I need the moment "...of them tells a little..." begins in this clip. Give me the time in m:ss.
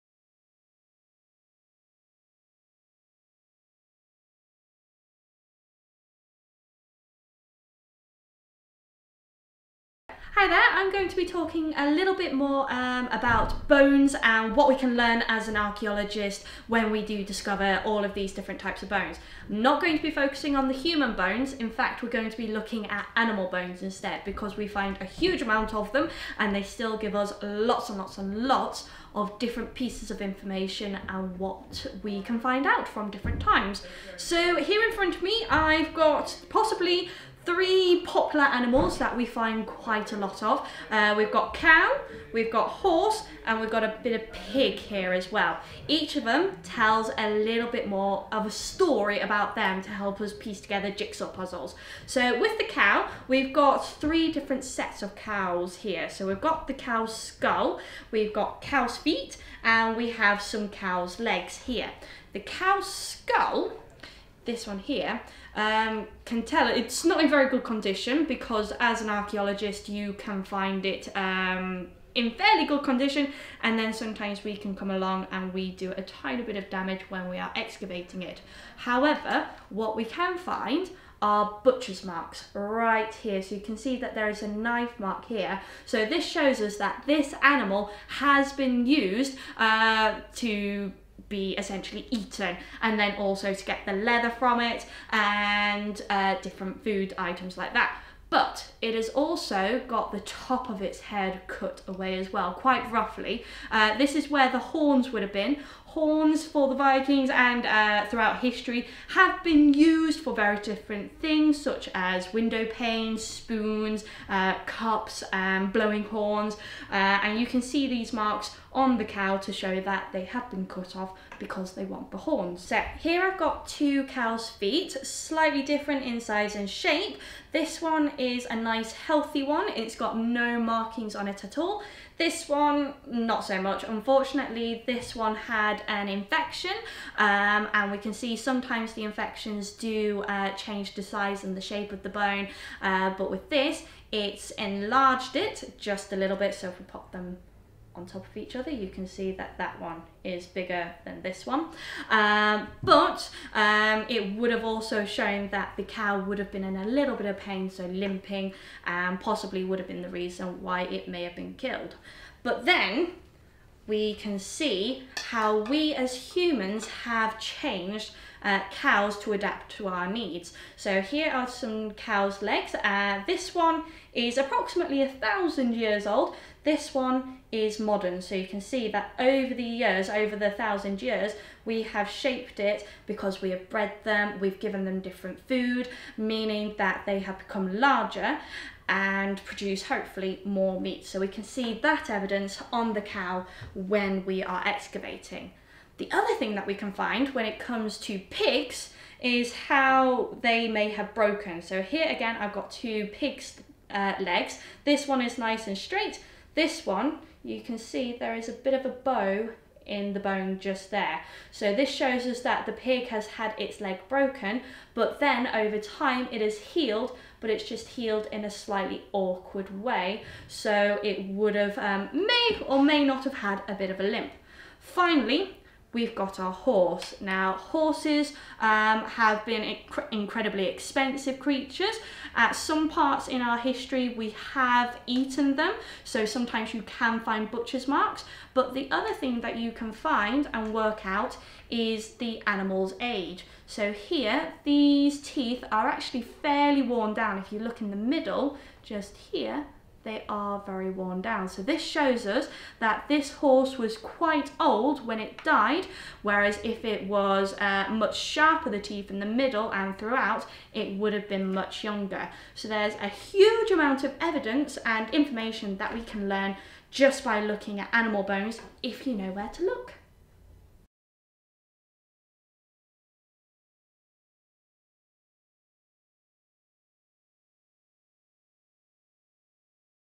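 0:46.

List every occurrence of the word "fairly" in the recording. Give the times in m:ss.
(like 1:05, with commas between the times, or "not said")
1:12, 4:06.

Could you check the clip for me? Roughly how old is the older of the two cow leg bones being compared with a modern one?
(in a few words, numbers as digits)
1000 years.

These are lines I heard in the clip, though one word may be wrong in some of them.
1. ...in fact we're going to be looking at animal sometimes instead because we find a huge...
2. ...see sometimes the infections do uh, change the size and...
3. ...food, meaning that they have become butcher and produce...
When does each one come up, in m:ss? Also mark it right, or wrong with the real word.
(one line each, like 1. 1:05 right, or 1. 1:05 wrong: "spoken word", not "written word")
1. 0:21 wrong: "bones", not "sometimes"
2. 2:18 right
3. 3:05 wrong: "larger", not "butcher".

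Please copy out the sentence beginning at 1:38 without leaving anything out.
But it has also got the top of its head cut away as well, quite roughly.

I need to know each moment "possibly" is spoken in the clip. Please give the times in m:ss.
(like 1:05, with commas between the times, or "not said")
0:36, 2:39.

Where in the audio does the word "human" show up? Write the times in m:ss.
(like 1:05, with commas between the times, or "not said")
0:20, 2:46.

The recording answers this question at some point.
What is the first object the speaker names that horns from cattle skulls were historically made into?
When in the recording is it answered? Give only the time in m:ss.
1:52.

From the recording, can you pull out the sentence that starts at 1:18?
However, what we can find are butcher's marks right here.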